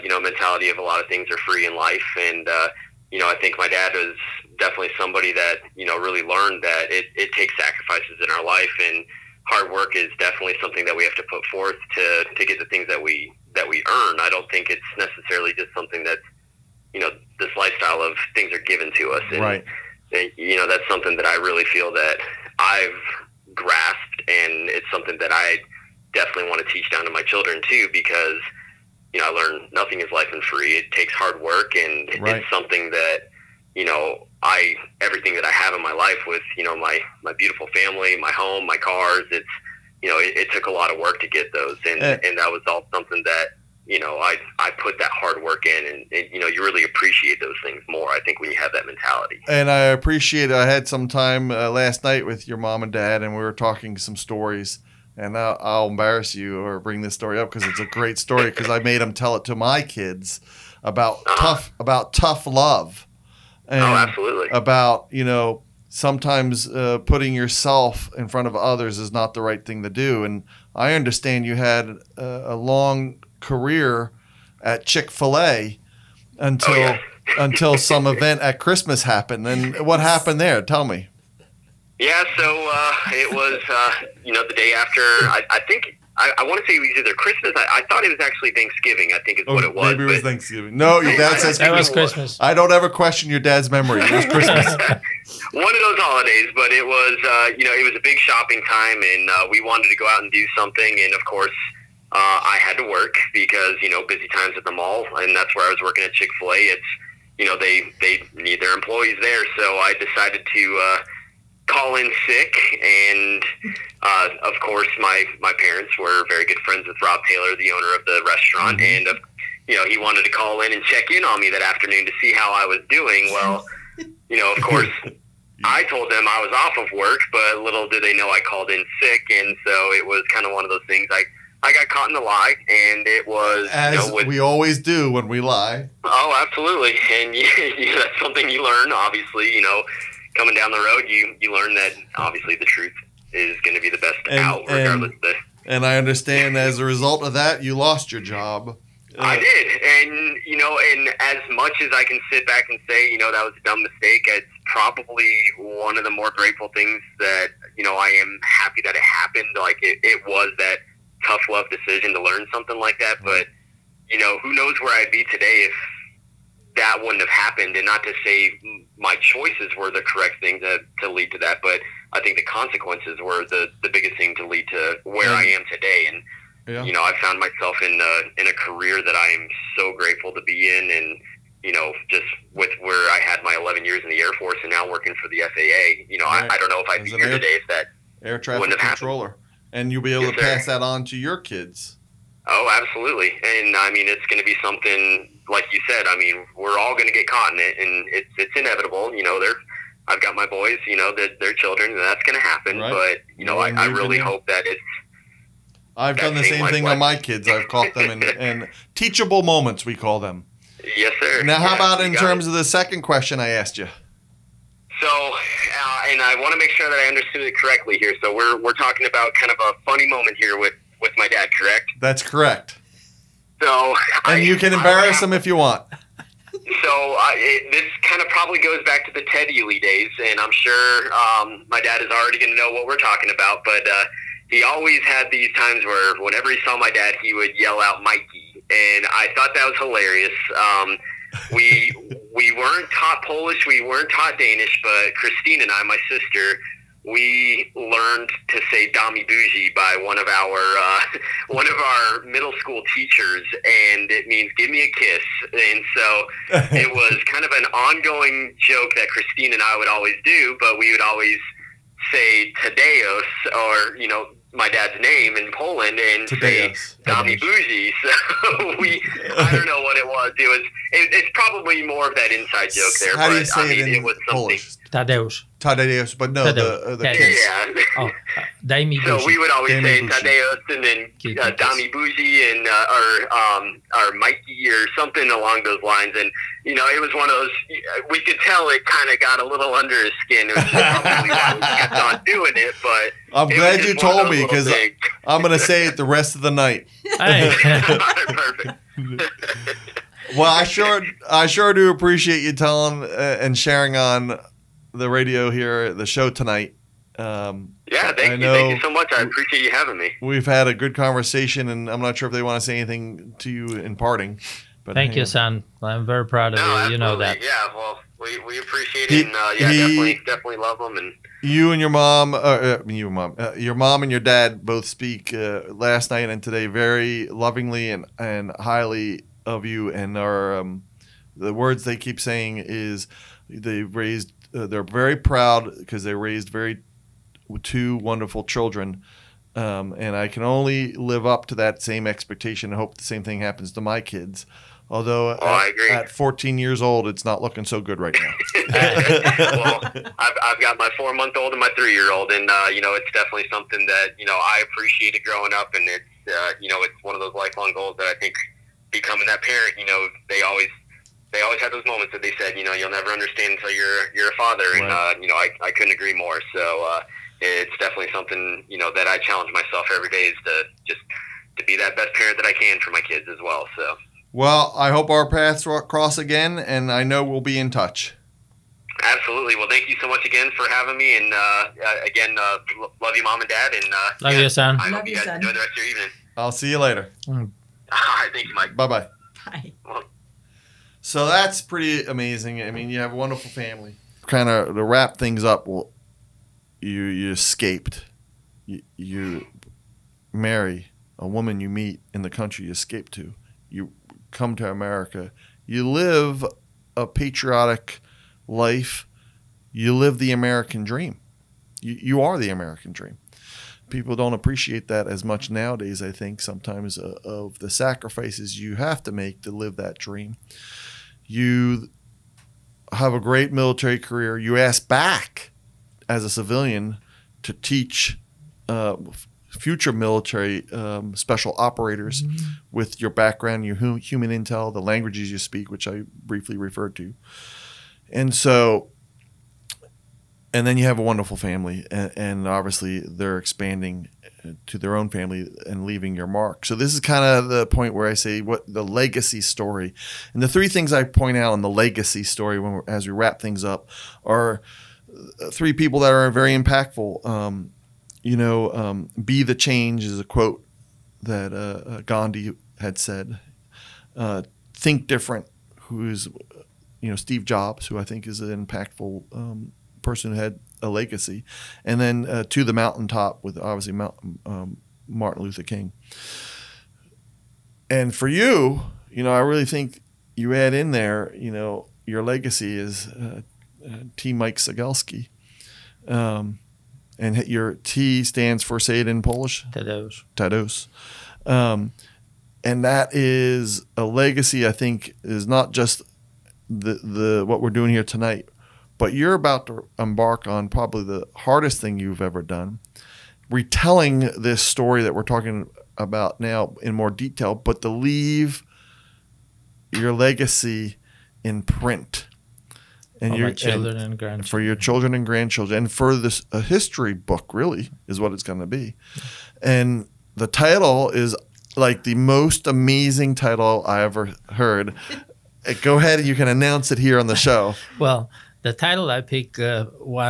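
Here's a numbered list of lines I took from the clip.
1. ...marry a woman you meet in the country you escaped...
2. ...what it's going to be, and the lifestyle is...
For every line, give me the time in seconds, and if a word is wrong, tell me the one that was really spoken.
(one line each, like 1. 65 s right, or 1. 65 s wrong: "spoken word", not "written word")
1. 400 s right
2. 518 s wrong: "title", not "lifestyle".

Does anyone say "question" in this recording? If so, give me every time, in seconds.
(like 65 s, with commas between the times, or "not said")
92 s, 213 s.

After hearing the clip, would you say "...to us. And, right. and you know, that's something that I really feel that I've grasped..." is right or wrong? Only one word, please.
right.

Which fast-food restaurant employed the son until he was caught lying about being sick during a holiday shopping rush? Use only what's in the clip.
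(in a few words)
Chick-fil-A.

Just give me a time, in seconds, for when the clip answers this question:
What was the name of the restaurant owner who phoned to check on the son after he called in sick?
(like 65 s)
117 s.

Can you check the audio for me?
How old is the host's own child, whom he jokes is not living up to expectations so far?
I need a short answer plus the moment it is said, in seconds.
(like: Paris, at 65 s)
14, at 346 s.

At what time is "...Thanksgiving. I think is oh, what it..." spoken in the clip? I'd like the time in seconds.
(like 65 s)
88 s.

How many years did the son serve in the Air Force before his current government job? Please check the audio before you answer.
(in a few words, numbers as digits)
11.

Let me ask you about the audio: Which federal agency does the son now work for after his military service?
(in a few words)
FAA.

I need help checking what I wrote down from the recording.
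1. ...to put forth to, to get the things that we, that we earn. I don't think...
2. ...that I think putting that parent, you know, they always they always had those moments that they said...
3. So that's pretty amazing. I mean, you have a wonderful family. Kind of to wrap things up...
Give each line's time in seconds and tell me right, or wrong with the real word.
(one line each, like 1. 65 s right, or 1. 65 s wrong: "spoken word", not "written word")
1. 11 s right
2. 357 s wrong: "becoming", not "putting"
3. 391 s right.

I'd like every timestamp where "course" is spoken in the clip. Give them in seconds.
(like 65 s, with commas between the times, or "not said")
101 s, 114 s, 124 s.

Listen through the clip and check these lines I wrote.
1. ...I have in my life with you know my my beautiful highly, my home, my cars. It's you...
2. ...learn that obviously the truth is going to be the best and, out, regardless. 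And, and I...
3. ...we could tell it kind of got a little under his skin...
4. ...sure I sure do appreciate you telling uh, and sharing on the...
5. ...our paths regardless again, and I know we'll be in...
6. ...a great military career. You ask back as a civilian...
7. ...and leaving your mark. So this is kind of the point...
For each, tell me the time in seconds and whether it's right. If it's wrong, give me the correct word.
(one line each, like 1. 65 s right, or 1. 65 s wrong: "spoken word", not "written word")
1. 35 s wrong: "family", not "highly"
2. 141 s right
3. 288 s right
4. 300 s right
5. 375 s wrong: "cross", not "regardless"
6. 423 s right
7. 445 s right.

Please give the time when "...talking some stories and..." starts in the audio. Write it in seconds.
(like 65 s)
53 s.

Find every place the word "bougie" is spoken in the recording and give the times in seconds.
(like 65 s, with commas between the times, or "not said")
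249 s, 267 s, 281 s.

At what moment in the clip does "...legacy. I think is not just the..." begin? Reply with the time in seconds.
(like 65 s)
494 s.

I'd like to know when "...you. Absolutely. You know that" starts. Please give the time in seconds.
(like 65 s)
316 s.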